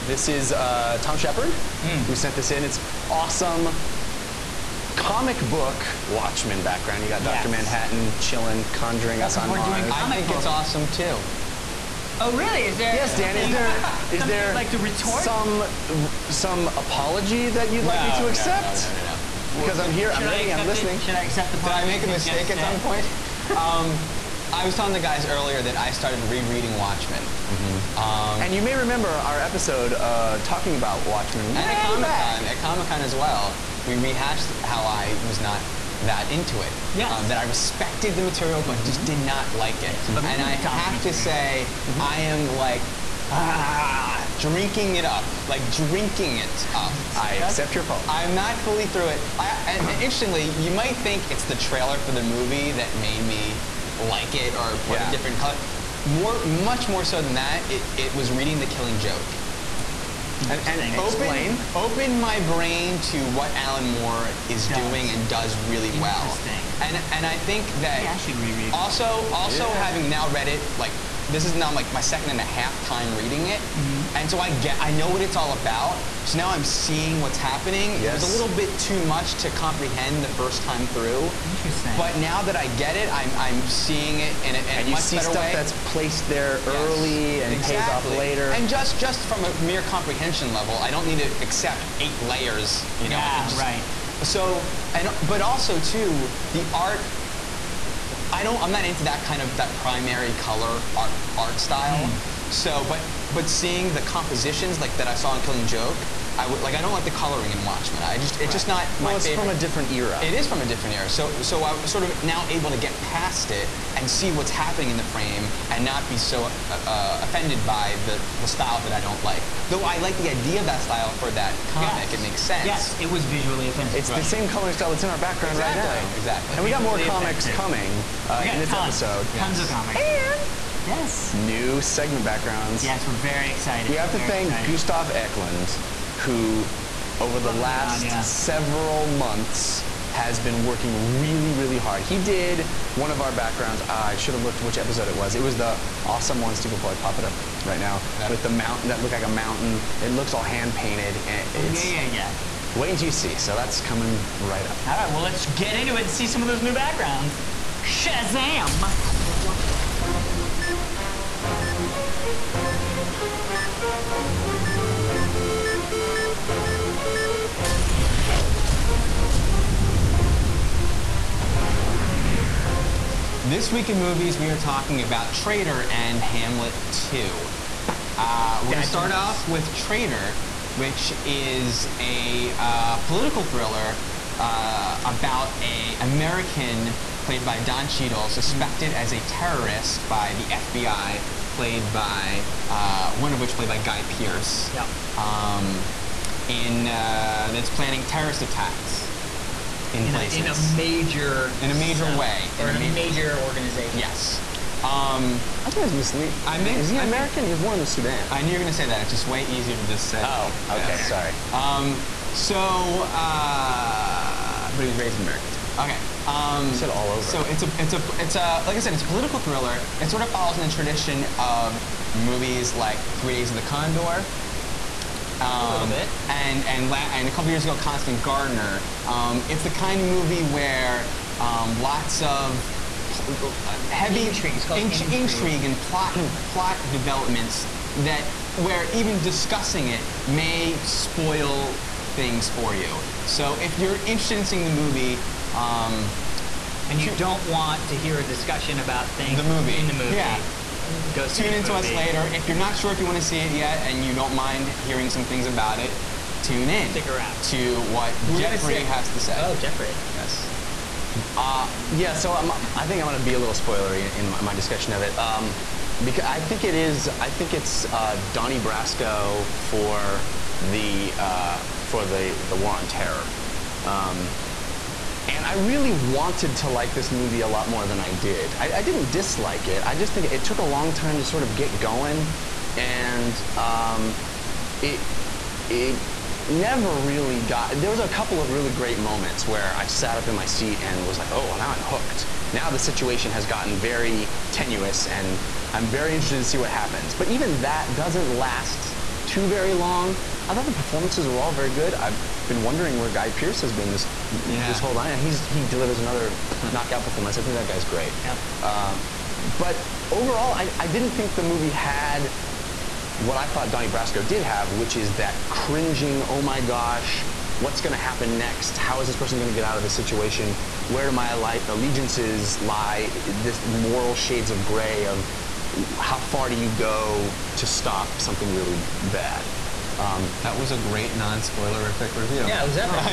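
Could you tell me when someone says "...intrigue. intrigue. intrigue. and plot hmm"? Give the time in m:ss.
3:54.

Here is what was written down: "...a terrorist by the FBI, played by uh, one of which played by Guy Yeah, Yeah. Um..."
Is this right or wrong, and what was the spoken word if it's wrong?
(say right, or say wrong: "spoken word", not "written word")
wrong: "Pearce", not "Yeah".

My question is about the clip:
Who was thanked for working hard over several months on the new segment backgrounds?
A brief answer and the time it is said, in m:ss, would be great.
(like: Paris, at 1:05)
Gustav Eklund, at 2:14.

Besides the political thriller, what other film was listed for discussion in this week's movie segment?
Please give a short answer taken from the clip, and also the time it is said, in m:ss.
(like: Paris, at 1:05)
Hamlet 2, at 2:56.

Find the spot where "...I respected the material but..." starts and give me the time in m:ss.
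0:37.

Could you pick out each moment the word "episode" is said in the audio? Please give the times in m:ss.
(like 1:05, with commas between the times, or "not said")
0:29, 2:09, 2:24.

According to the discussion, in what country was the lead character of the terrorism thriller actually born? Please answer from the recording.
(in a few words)
Sudan.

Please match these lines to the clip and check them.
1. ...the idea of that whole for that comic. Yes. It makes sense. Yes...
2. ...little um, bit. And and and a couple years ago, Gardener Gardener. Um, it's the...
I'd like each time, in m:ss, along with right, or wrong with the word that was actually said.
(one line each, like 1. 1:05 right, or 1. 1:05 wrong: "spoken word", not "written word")
1. 2:00 wrong: "style", not "whole"
2. 3:45 wrong: "Constant", not "Gardener".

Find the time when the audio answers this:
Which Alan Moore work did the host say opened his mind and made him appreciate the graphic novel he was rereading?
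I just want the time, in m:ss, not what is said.
0:58.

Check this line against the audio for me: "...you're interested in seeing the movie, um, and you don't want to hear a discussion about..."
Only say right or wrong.
right.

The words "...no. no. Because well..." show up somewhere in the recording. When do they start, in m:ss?
0:19.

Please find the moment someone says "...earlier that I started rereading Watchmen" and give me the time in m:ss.
0:25.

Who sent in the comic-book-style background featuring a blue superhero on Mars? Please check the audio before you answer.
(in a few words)
Tom Shepard.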